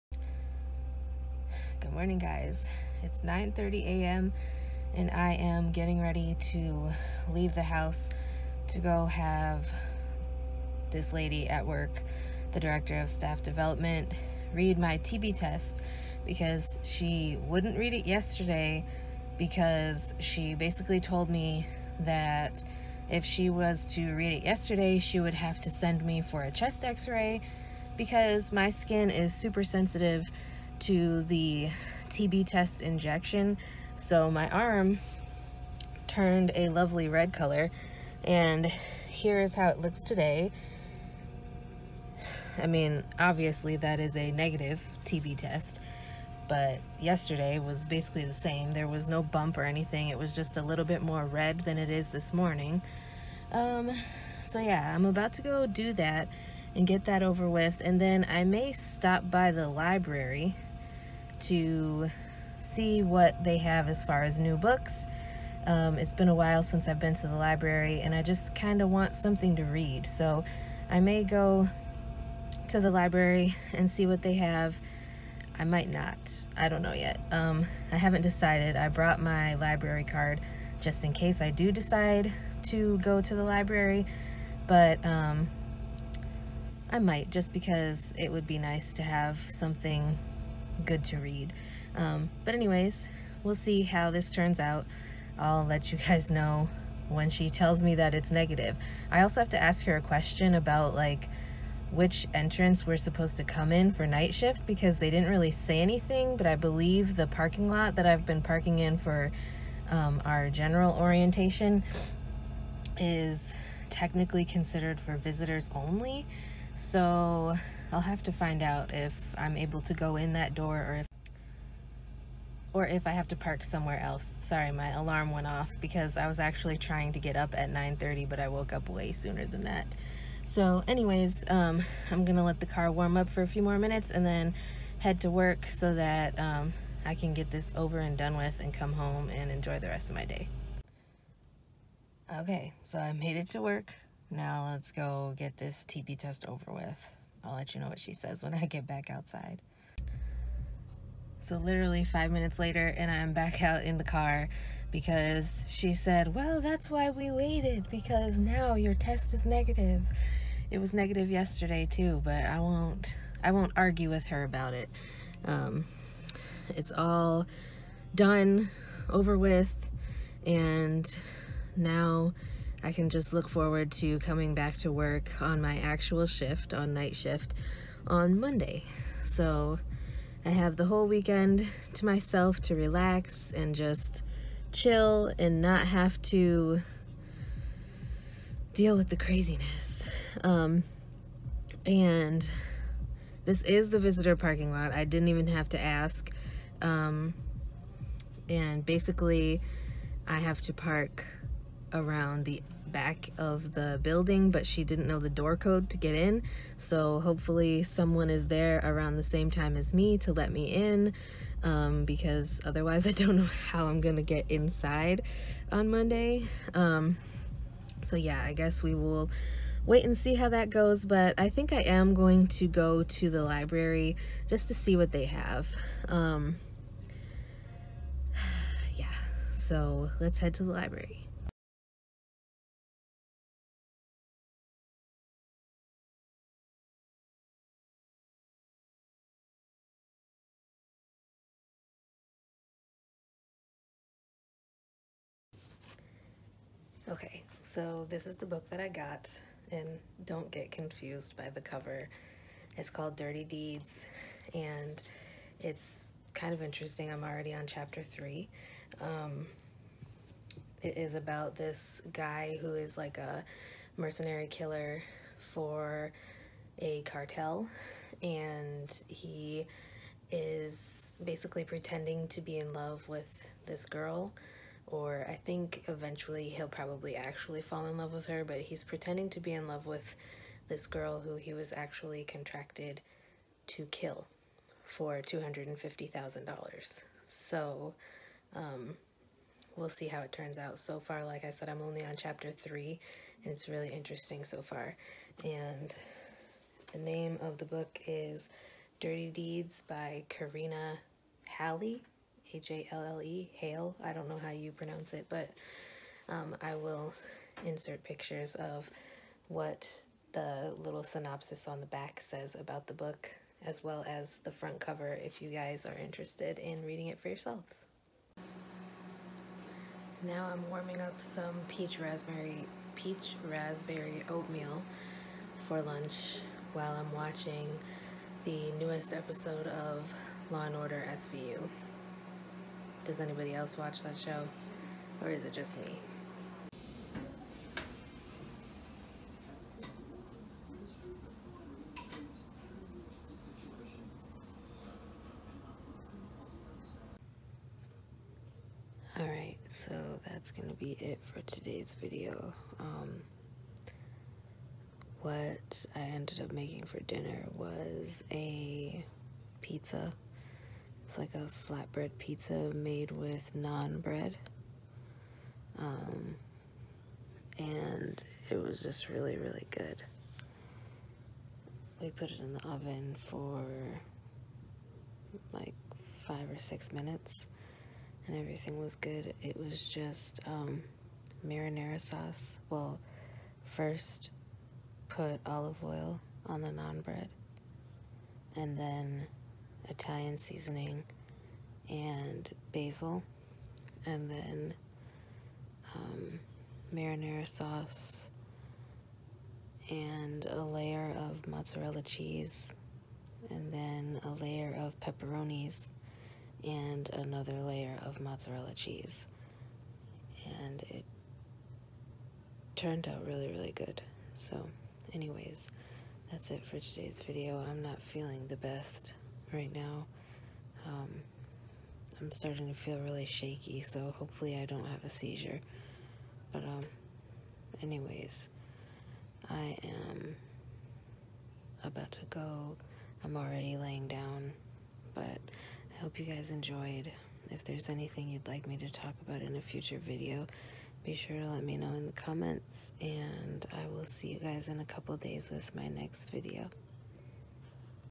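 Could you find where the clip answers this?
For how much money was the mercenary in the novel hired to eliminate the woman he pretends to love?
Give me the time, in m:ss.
4:45.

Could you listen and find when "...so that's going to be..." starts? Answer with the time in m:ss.
5:49.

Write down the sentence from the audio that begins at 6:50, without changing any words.
And it turned out really, really good.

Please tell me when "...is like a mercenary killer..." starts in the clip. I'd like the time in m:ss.
4:22.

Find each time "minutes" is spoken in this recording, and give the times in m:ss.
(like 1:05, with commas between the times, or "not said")
2:13, 2:32, 6:16.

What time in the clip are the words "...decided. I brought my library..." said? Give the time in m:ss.
1:18.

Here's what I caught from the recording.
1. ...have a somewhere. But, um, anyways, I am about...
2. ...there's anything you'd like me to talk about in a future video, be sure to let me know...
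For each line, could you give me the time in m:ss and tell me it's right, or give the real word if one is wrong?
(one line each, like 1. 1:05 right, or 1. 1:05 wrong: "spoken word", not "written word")
1. 7:04 wrong: "seizure", not "somewhere"
2. 7:17 right.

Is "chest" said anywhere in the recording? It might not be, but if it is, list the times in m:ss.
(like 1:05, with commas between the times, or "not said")
0:26.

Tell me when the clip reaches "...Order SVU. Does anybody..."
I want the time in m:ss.
5:30.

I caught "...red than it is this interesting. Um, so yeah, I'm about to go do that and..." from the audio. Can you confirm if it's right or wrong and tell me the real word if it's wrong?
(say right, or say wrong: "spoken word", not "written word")
wrong: "morning", not "interesting".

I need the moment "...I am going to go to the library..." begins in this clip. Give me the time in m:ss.
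3:41.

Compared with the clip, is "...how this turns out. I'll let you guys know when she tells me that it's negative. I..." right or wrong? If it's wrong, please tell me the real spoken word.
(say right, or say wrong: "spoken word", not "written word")
right.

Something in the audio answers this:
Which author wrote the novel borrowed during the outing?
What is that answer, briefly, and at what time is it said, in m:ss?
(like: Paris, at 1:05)
Karina Halle, at 5:00.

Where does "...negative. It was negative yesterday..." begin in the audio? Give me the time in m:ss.
2:39.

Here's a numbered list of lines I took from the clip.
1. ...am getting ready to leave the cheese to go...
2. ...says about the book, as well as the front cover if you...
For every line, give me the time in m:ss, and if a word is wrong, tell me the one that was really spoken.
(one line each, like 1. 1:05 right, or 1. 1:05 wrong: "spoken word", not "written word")
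1. 0:05 wrong: "house", not "cheese"
2. 5:12 right.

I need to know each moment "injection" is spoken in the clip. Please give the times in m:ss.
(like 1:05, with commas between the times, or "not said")
0:32.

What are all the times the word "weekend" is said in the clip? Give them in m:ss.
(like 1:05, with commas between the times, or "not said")
3:01.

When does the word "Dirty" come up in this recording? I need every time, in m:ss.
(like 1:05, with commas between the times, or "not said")
4:13, 4:58.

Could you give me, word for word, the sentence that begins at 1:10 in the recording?
So I may go to the library and see what they have.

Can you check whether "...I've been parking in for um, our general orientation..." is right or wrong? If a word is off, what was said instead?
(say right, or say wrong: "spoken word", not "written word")
right.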